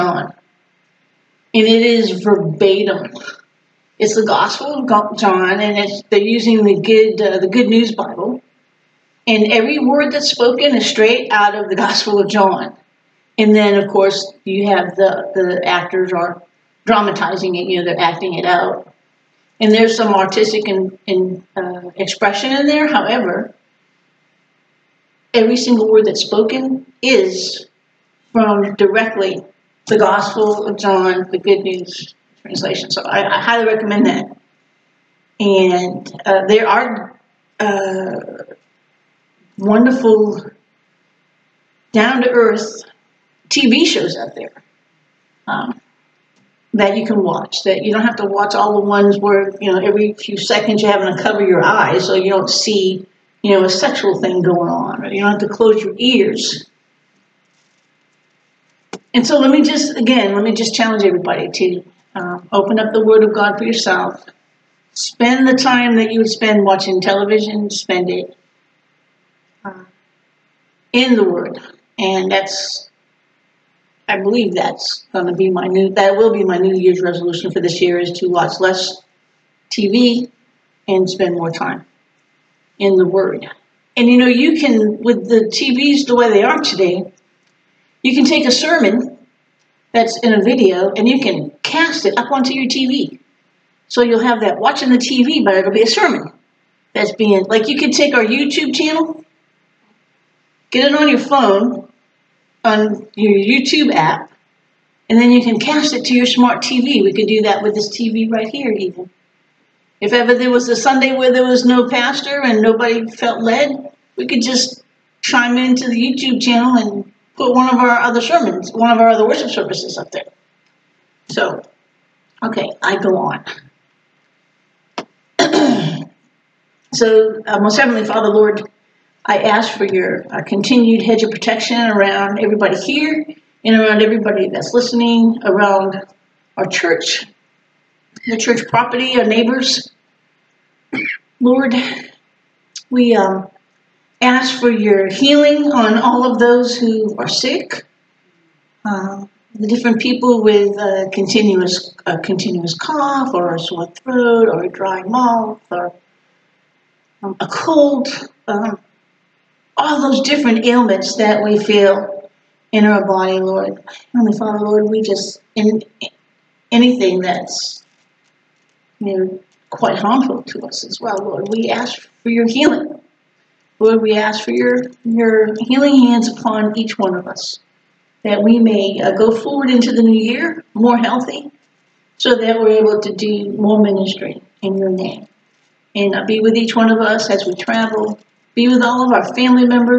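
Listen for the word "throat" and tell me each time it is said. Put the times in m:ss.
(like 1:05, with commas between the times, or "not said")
2:33.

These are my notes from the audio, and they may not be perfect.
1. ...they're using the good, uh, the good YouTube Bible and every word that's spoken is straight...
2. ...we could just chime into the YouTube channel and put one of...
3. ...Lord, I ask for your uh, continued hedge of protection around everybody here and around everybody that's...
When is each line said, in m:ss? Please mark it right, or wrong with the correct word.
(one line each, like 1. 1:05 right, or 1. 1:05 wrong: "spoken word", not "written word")
1. 0:06 wrong: "News", not "YouTube"
2. 1:54 right
3. 2:08 right.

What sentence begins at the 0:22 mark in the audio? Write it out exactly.
However, every single word that's spoken is from directly the Gospel of John, the Good News translation.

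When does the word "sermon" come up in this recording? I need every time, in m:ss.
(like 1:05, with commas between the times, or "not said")
1:28, 1:35, 1:58.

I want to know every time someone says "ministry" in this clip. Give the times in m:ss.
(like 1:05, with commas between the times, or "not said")
3:03.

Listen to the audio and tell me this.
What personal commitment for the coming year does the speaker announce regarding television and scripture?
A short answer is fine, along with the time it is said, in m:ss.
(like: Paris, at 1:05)
Watch less TV, at 1:18.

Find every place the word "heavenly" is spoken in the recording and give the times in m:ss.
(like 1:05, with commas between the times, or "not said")
2:07, 2:44.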